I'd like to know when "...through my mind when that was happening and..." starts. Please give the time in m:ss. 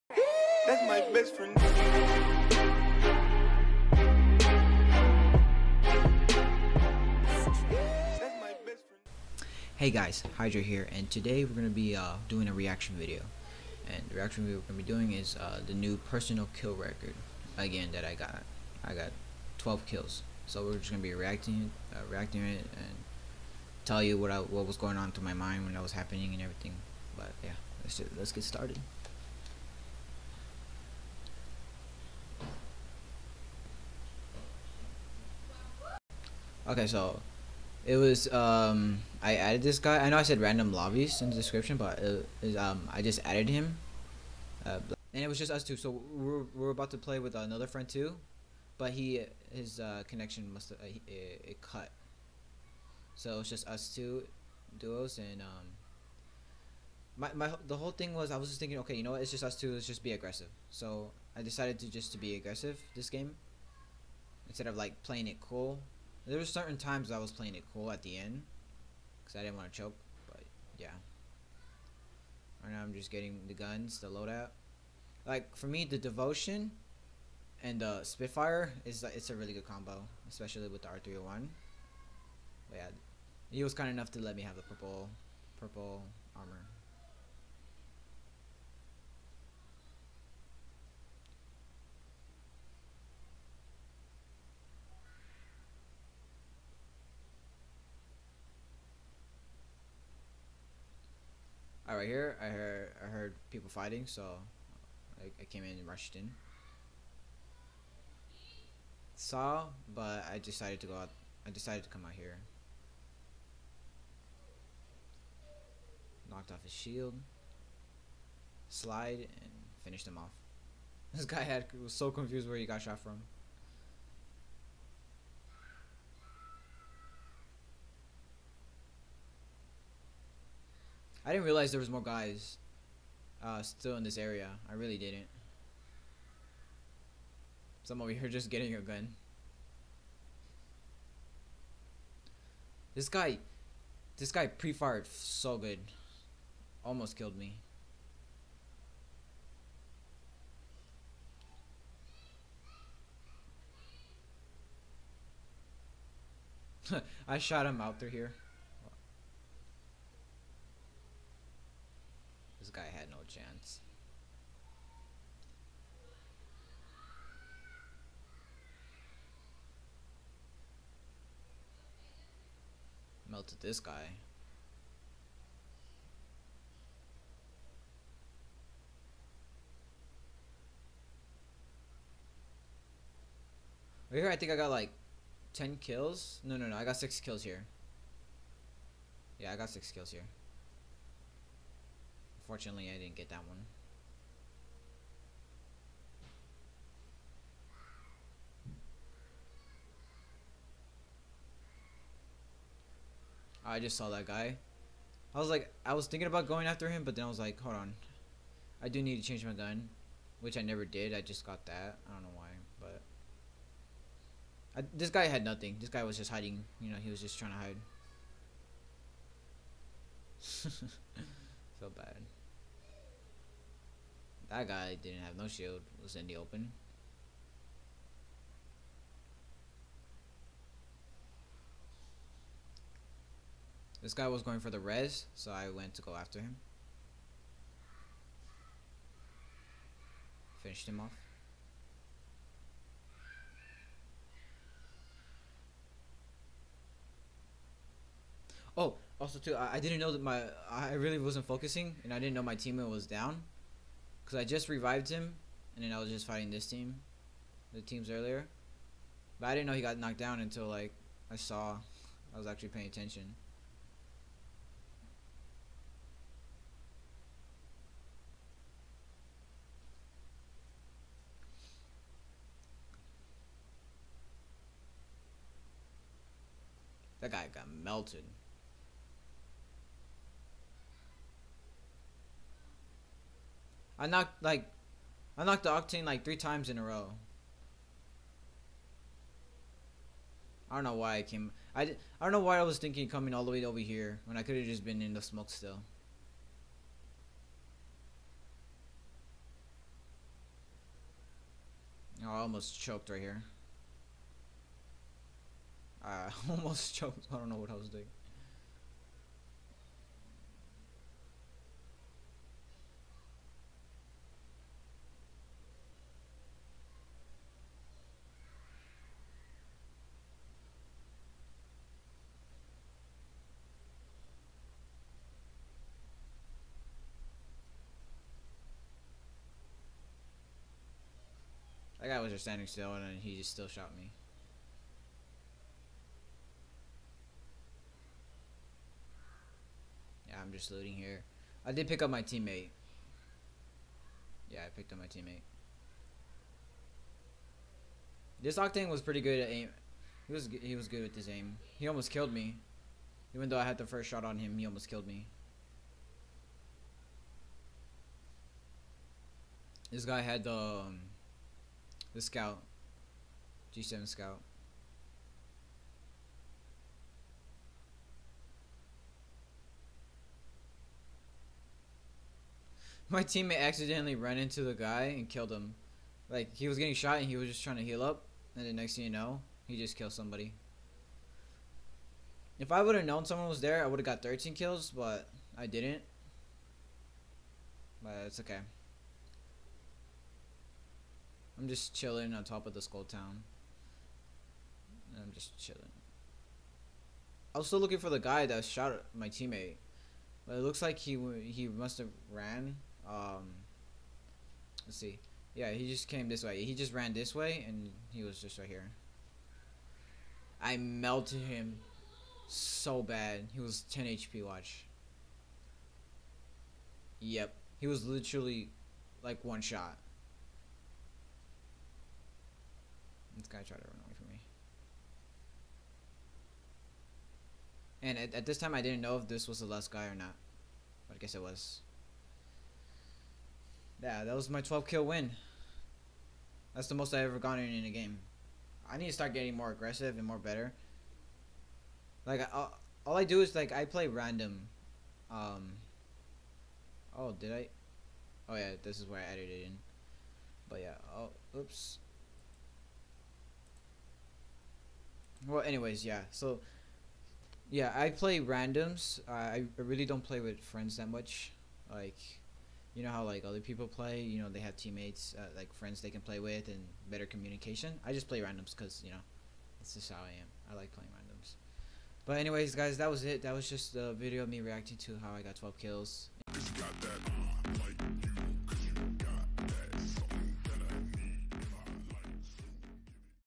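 0:25.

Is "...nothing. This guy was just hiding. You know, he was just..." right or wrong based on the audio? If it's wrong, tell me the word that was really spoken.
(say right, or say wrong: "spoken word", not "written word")
right.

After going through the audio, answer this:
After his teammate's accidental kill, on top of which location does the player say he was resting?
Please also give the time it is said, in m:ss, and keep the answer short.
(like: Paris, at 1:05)
Skull Town, at 6:32.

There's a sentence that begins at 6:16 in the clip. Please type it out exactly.
Like, he was getting shot and he was just trying to heal up.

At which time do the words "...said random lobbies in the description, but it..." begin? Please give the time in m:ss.
0:40.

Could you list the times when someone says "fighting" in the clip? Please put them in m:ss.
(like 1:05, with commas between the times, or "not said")
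1:43, 4:16.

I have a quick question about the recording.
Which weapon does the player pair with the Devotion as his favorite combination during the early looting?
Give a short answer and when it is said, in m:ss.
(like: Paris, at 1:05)
Spitfire, at 1:18.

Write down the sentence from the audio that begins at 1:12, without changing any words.
Right now I'm just getting the guns, the loadout.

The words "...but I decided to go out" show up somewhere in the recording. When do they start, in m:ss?
1:49.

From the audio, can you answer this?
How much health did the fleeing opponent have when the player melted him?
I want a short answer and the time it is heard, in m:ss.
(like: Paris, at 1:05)
10 HP, at 6:53.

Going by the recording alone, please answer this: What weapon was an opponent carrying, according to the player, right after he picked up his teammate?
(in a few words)
G7 Scout.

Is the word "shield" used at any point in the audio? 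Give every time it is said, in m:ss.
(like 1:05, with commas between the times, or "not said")
1:56, 3:45.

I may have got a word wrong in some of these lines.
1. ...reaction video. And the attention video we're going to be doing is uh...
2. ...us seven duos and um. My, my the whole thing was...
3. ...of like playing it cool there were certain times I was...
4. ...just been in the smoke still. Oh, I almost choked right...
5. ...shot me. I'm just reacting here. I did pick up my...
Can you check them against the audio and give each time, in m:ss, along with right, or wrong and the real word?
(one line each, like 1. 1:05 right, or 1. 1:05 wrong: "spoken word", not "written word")
1. 0:12 wrong: "reaction", not "attention"
2. 0:53 wrong: "two", not "seven"
3. 1:04 right
4. 4:54 right
5. 5:33 wrong: "looting", not "reacting".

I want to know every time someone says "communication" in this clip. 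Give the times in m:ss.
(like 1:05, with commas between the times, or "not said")
7:47.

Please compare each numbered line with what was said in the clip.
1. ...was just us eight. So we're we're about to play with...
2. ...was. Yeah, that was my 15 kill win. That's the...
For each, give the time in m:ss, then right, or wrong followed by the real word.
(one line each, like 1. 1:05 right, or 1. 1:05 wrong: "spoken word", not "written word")
1. 0:45 wrong: "two", not "eight"
2. 7:11 wrong: "12", not "15".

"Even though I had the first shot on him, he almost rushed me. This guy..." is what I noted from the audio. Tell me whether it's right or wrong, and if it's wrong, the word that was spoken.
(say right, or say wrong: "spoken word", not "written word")
wrong: "killed", not "rushed".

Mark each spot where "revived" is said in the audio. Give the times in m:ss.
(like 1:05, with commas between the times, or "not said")
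4:14.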